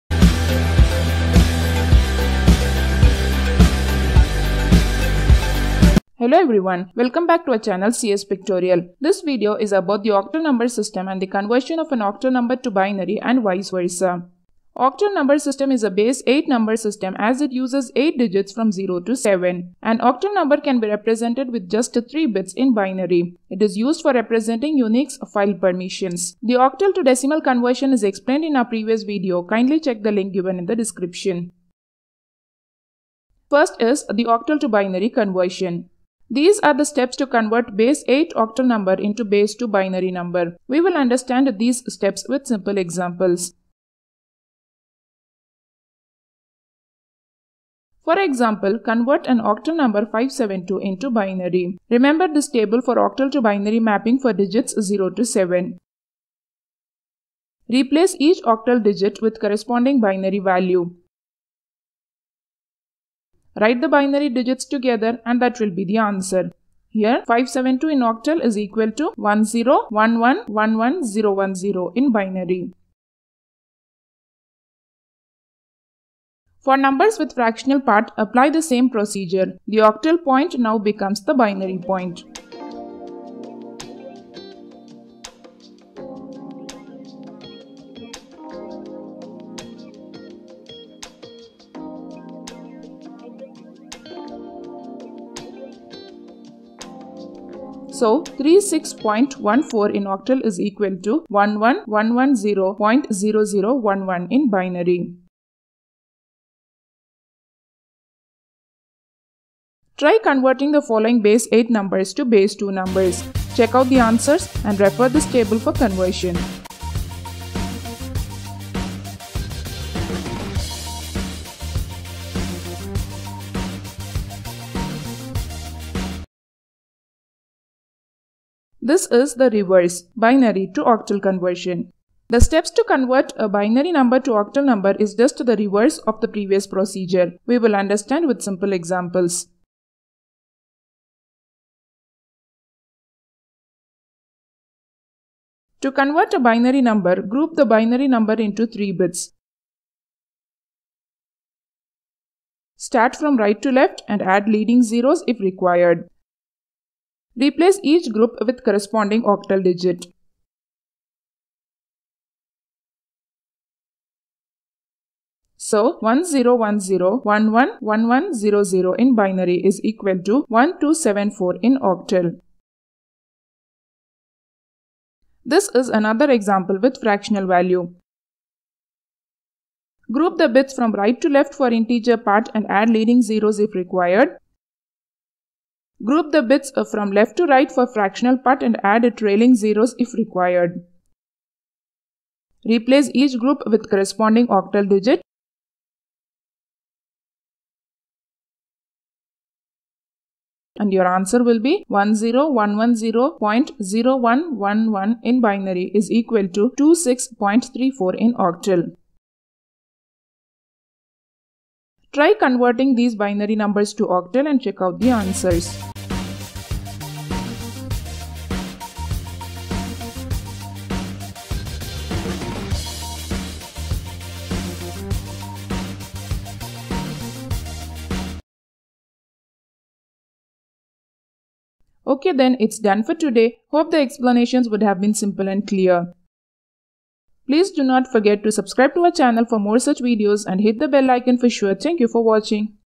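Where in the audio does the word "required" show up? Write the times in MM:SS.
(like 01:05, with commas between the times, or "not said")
02:35, 03:03, 03:10.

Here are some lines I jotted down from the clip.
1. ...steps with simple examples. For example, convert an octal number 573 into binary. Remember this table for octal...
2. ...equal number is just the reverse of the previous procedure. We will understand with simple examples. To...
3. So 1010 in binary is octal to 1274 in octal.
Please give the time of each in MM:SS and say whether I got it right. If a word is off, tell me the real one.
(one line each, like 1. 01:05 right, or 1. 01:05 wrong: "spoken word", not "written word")
1. 00:41 wrong: "572", not "573"
2. 02:14 wrong: "octal", not "equal"
3. 02:45 wrong: "equal", not "octal".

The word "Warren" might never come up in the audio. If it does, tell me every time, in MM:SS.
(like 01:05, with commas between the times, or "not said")
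not said.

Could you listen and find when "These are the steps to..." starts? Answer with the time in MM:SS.
00:36.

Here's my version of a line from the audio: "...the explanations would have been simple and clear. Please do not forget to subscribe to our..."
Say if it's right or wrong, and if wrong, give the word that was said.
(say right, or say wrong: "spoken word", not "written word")
right.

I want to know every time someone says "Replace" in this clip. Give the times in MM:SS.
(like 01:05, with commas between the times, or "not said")
00:57, 02:37, 03:12.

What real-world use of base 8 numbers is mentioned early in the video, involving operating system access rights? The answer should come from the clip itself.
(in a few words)
Unix file permissions.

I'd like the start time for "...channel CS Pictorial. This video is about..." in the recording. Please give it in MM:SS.
00:07.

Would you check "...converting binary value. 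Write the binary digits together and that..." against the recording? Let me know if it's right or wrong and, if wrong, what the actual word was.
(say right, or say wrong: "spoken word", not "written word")
wrong: "corresponding", not "converting".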